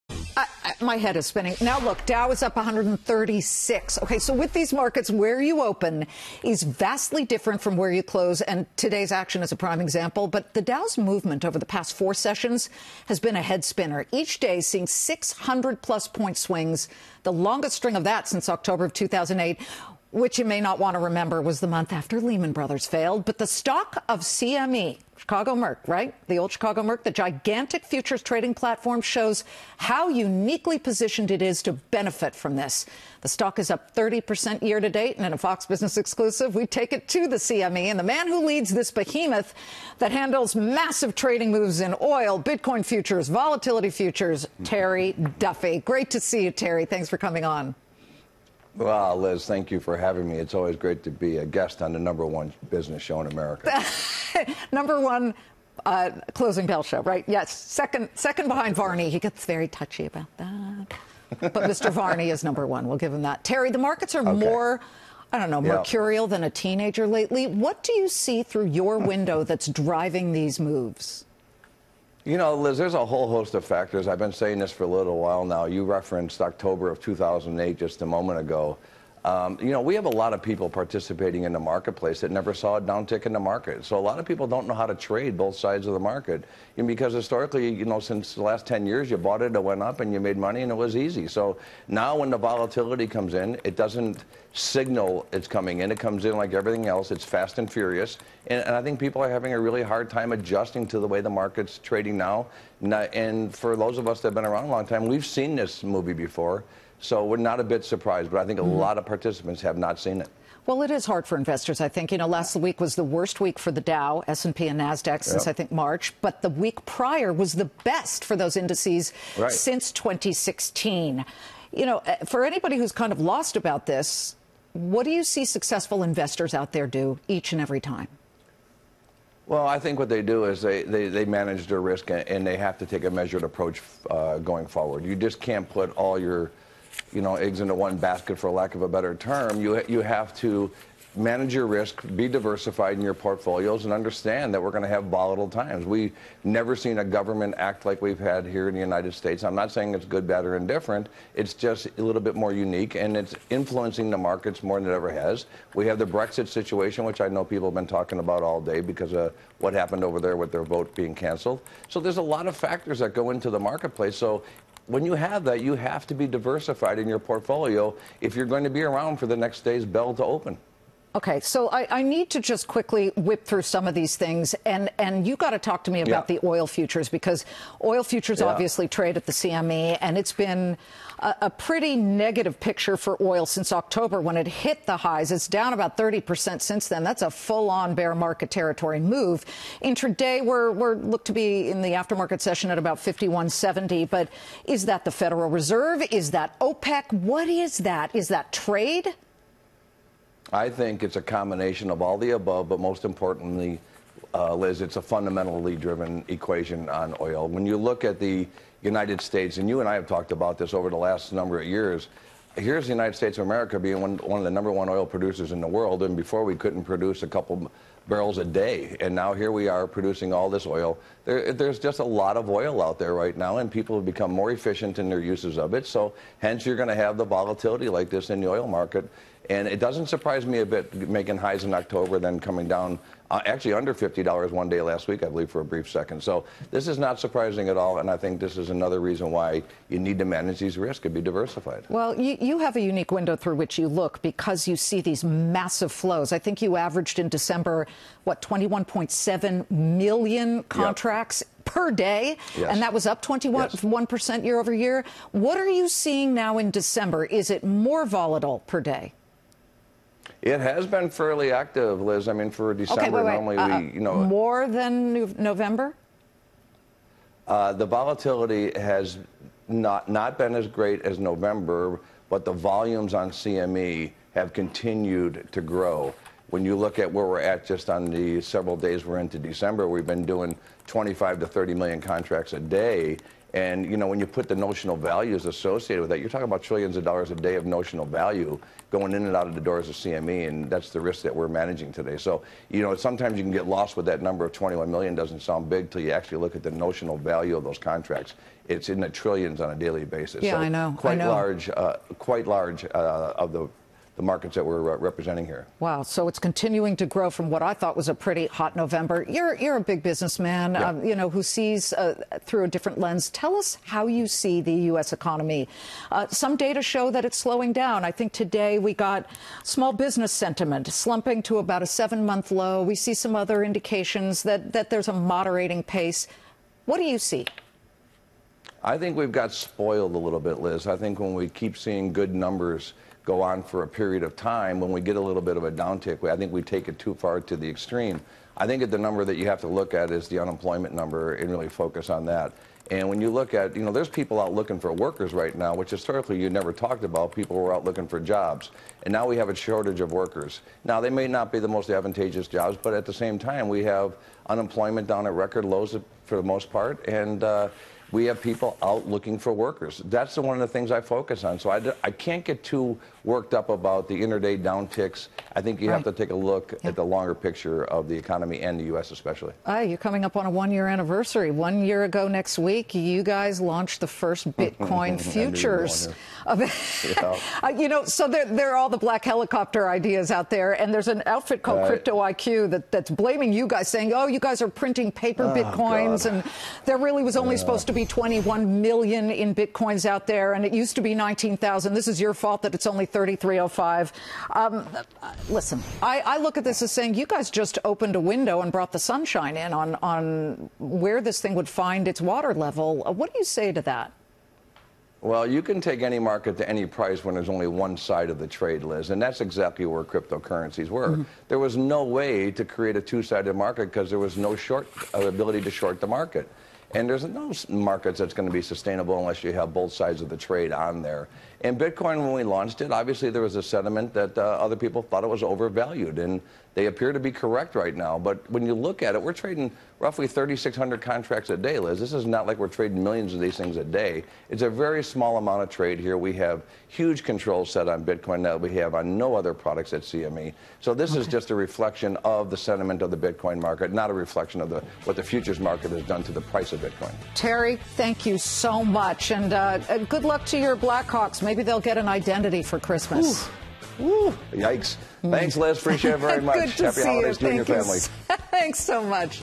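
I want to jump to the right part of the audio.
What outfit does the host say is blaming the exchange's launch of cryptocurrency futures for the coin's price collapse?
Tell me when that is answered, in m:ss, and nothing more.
6:21.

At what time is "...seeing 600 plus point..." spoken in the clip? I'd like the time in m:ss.
0:14.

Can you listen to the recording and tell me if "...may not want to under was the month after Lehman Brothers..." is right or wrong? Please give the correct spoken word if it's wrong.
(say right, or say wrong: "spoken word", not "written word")
wrong: "remember", not "under".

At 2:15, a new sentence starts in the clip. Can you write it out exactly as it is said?
You just can't put all your you know, eggs into one basket, for lack of a better term.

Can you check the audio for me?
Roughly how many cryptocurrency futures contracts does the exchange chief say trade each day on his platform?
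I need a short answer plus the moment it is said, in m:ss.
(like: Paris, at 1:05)
3,600, at 7:10.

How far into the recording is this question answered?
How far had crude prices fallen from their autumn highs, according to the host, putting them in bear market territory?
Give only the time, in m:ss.
3:05.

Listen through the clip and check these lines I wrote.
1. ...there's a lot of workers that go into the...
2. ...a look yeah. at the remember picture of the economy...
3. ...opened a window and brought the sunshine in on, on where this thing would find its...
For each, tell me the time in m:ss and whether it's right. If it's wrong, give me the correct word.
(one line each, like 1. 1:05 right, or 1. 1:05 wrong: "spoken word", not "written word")
1. 2:41 wrong: "factors", not "workers"
2. 6:06 wrong: "longer", not "remember"
3. 6:37 right.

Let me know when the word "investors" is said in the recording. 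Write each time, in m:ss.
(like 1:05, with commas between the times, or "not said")
1:51, 2:06.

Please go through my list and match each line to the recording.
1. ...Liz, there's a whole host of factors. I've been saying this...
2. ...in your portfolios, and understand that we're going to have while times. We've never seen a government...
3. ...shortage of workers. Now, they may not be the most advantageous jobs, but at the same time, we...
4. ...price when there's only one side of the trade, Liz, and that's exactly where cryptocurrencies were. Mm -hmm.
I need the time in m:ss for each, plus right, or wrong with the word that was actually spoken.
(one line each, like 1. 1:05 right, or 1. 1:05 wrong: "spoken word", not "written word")
1. 1:12 right
2. 2:22 wrong: "volatile", not "while"
3. 5:49 right
4. 6:46 right.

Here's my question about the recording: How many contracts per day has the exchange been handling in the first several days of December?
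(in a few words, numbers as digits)
25 to 30 million.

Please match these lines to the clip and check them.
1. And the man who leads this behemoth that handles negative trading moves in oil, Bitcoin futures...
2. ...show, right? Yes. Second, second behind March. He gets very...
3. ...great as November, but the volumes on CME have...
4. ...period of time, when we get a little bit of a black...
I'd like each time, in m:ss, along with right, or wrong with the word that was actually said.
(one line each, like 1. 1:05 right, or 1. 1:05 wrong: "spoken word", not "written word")
1. 0:37 wrong: "massive", not "negative"
2. 0:56 wrong: "Varney", not "March"
3. 4:30 right
4. 5:33 wrong: "downtick", not "black".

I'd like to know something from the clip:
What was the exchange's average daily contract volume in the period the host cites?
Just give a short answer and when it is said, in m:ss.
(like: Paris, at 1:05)
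21.7 million, at 4:08.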